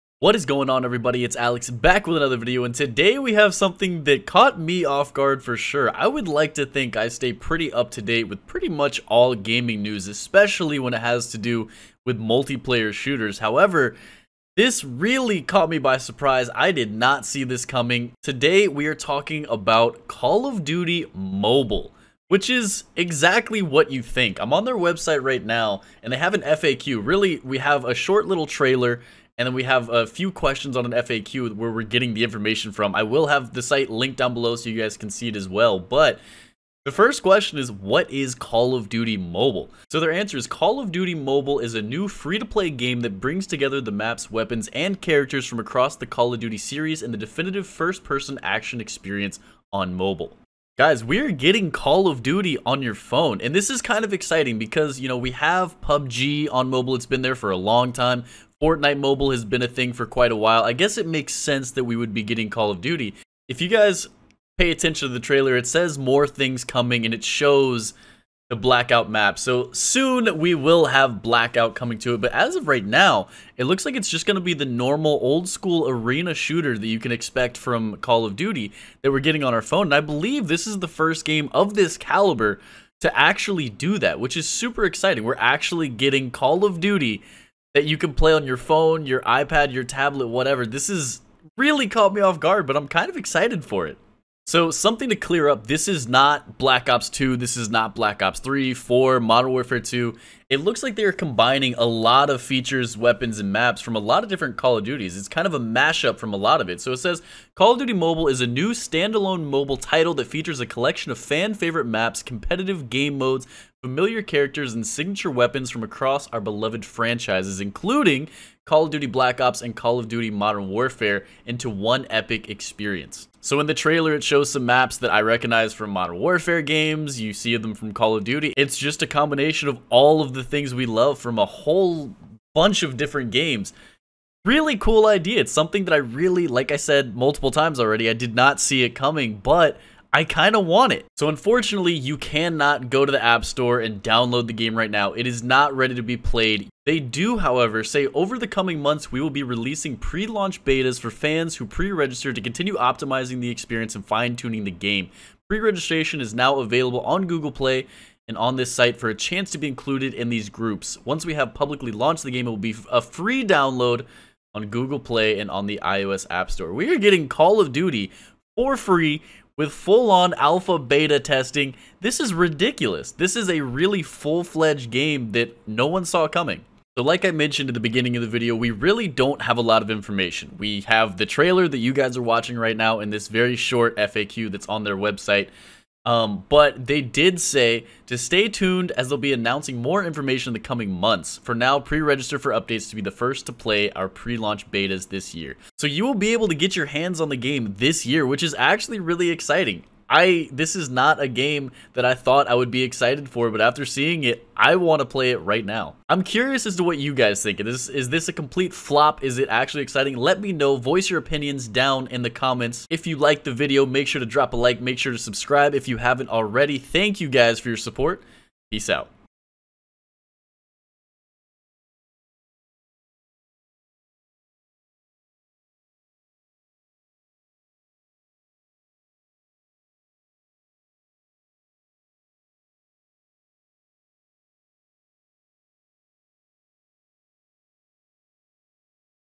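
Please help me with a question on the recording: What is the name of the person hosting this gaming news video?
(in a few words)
Alex.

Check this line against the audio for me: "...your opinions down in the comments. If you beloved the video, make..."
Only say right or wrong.
wrong.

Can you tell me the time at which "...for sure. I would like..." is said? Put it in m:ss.
0:05.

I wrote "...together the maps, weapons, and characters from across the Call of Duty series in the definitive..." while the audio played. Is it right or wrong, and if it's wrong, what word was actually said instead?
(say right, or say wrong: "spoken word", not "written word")
right.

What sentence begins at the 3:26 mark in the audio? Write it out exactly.
I'm curious as to what you guys think.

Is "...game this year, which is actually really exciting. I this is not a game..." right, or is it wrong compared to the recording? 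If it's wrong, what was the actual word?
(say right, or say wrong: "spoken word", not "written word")
right.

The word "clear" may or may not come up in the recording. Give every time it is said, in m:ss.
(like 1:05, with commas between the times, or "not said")
1:35.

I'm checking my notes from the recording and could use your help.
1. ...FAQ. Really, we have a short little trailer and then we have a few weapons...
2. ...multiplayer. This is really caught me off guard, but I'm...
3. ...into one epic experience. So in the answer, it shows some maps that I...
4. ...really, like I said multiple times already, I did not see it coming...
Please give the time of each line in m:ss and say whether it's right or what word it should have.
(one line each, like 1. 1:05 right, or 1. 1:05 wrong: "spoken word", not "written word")
1. 0:26 wrong: "questions", not "weapons"
2. 1:30 wrong: "whatever", not "multiplayer"
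3. 2:01 wrong: "trailer", not "answer"
4. 2:15 right.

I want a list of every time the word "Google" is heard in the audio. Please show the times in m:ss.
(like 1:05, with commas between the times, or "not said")
2:37, 2:44.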